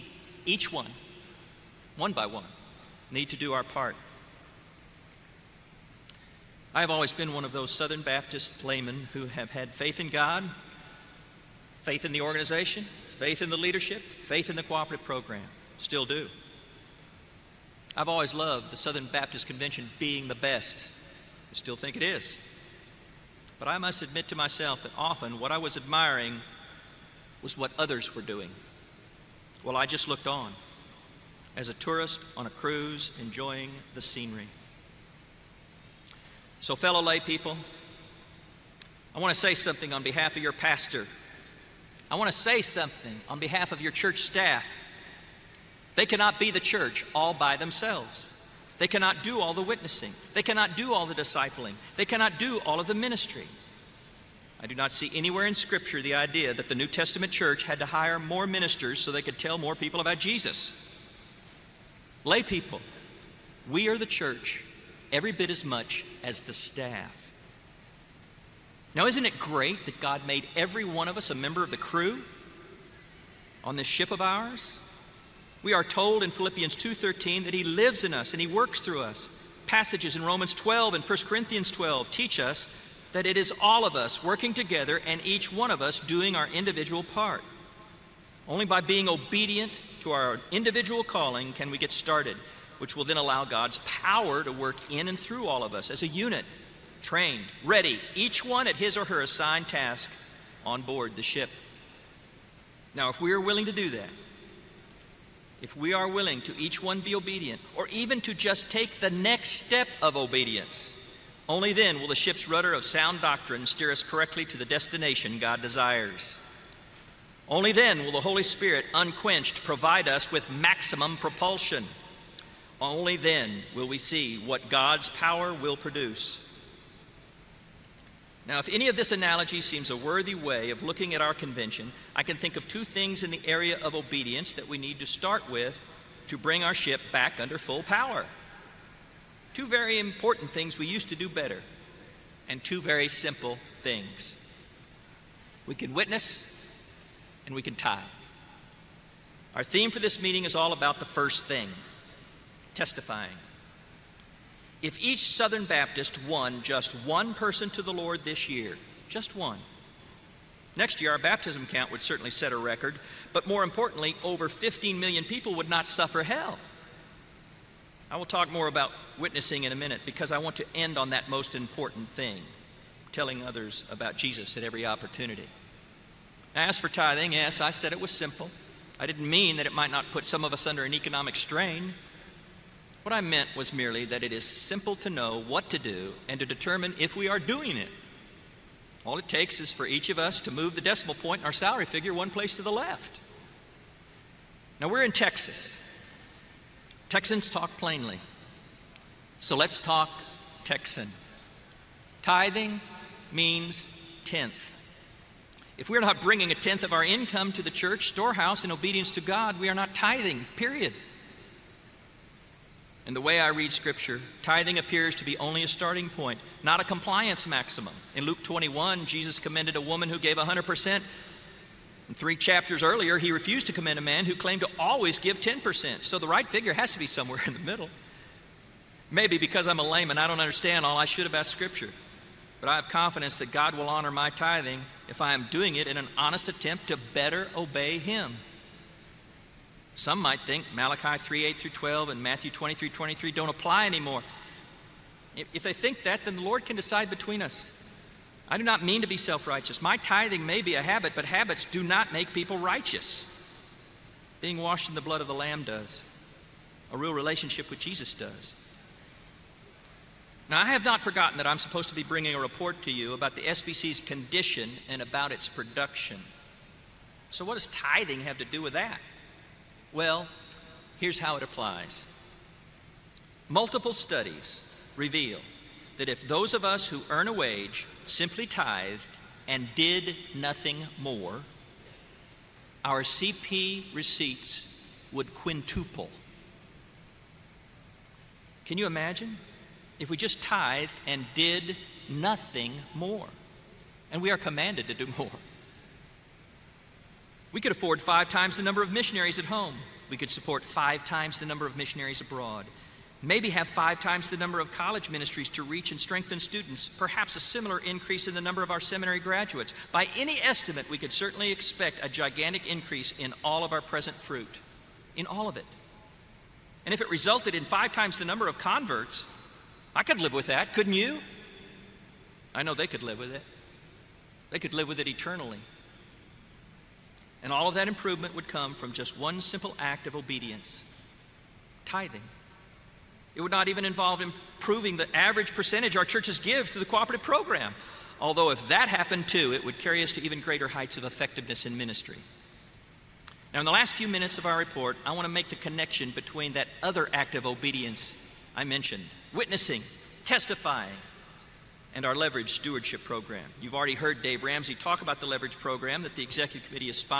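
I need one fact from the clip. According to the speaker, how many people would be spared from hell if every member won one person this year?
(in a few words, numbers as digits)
over 15 million.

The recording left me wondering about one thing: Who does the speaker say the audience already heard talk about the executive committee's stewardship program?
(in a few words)
Dave Ramsey.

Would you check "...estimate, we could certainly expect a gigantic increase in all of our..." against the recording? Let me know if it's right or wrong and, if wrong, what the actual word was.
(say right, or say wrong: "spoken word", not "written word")
right.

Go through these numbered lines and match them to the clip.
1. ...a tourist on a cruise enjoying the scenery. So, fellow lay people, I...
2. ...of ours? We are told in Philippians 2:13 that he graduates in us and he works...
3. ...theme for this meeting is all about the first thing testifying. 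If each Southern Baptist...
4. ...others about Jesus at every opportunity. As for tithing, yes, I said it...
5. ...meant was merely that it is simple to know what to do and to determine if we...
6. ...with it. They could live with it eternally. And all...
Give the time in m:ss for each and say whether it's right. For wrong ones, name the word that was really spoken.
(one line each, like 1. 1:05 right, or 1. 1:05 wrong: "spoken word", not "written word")
1. 0:31 right
2. 1:14 wrong: "lives", not "graduates"
3. 2:29 right
4. 2:53 right
5. 3:03 right
6. 5:23 right.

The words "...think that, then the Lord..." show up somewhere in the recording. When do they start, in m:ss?
4:05.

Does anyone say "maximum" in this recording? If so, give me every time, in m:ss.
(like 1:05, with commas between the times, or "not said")
2:00, 3:37.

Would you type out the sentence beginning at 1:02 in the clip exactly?
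Lay people, we are the church every bit as much as the staff.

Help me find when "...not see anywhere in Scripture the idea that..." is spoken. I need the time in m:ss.
0:54.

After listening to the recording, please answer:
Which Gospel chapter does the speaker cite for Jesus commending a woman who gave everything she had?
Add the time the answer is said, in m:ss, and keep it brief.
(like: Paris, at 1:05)
Luke 21, at 3:38.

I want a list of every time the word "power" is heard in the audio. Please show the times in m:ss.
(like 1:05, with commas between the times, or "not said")
1:33, 2:05, 2:17.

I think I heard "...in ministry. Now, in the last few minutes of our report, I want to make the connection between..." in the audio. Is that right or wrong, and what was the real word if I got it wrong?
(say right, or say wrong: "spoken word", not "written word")
right.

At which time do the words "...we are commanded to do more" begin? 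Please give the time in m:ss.
4:54.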